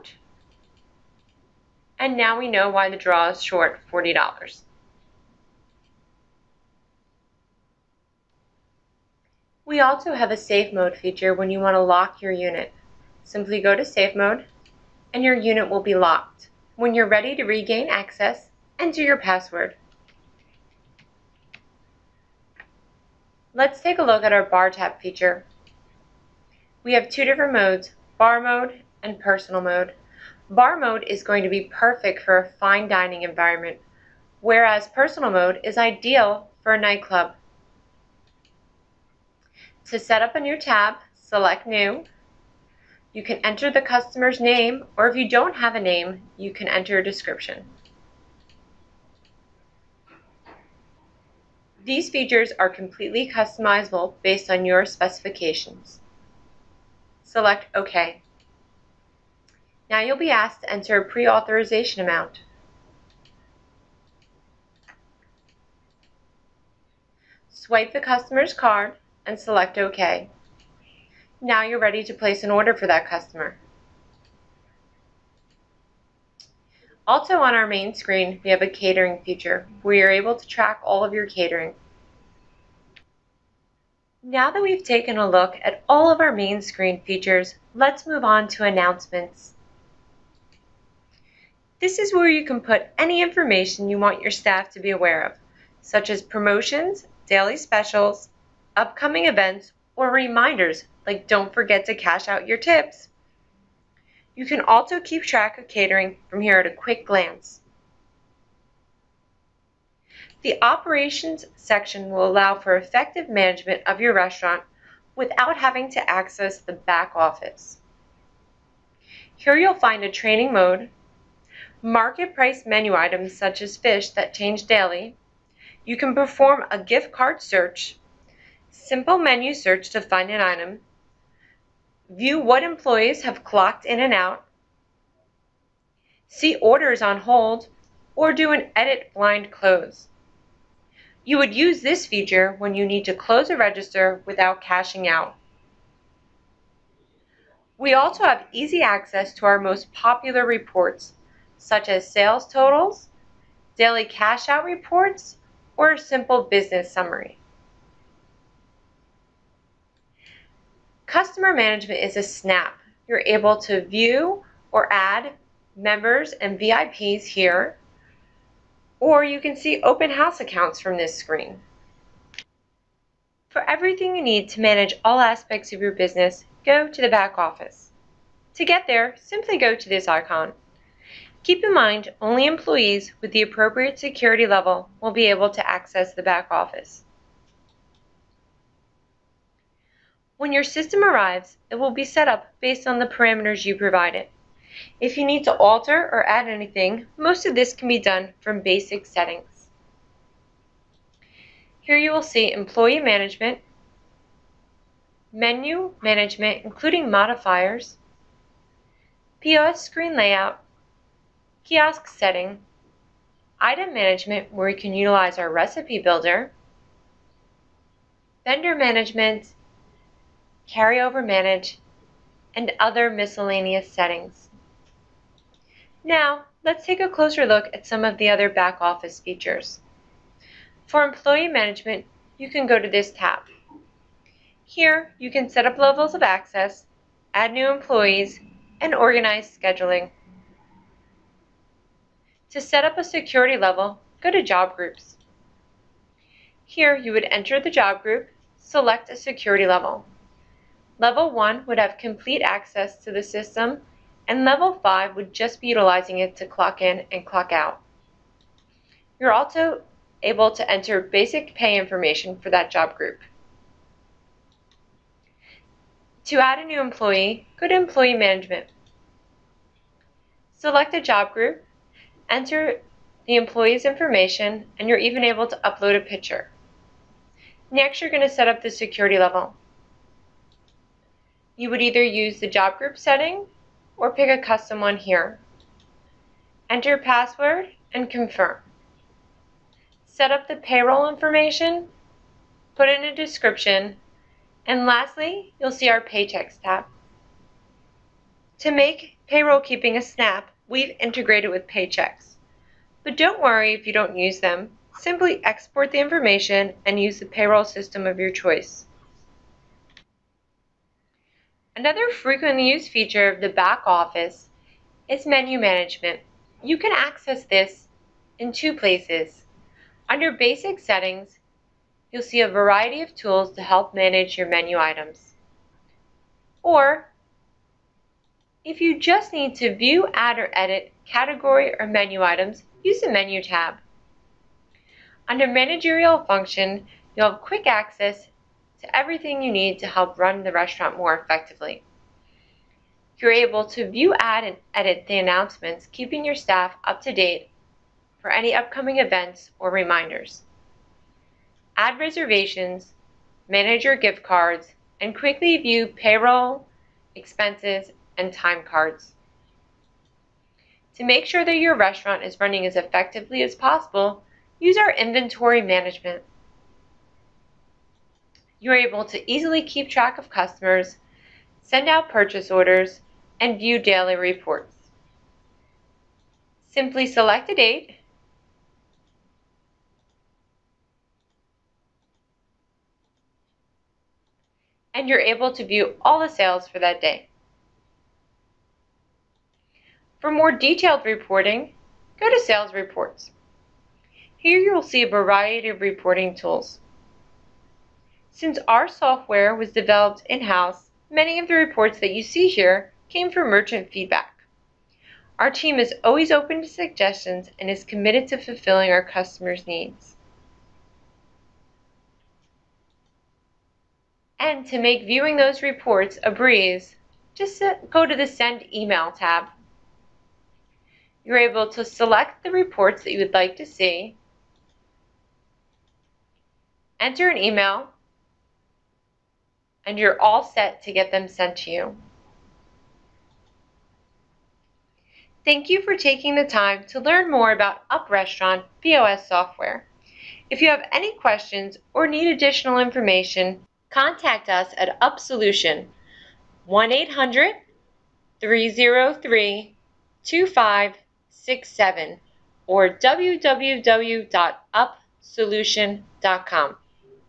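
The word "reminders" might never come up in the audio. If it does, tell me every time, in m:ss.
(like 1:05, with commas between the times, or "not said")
1:40, 5:49.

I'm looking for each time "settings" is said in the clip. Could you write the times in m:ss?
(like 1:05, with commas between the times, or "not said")
3:19, 3:32, 3:43, 4:42, 5:20.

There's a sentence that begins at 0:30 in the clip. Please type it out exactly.
Bar mode is going to be perfect for a fine dining environment, whereas personal mode is ideal for a nightclub.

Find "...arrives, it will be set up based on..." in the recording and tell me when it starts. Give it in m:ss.
3:11.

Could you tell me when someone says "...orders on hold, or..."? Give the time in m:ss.
2:16.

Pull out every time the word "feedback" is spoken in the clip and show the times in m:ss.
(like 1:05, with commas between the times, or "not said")
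6:43.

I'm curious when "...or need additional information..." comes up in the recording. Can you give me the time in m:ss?
7:21.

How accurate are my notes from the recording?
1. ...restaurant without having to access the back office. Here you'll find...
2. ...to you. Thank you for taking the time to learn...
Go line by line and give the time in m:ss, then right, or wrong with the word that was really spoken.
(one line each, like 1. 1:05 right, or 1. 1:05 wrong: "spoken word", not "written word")
1. 1:54 right
2. 7:11 right.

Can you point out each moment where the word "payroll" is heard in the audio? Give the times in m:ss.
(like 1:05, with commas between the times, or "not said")
4:50, 4:59, 5:07, 5:55.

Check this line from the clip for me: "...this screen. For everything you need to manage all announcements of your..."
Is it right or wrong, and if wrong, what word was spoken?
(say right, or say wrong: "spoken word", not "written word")
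wrong: "aspects", not "announcements".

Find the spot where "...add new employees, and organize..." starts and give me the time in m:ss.
3:57.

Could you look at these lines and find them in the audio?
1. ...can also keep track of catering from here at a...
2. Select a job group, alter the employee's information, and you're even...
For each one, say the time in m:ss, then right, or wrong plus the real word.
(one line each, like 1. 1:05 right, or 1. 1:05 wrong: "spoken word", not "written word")
1. 1:44 right
2. 4:30 wrong: "enter", not "alter".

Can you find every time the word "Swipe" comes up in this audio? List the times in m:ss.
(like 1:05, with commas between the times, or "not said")
1:07.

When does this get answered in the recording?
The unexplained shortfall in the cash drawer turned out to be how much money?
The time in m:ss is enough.
0:03.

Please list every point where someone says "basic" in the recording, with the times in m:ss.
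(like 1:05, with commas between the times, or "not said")
3:18, 4:21, 5:20.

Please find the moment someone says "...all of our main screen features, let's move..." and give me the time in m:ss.
1:25.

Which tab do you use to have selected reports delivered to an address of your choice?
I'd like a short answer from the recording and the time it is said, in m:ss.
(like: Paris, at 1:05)
Send Email, at 6:58.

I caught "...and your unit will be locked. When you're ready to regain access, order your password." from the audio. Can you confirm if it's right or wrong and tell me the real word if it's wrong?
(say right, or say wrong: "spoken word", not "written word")
wrong: "enter", not "order".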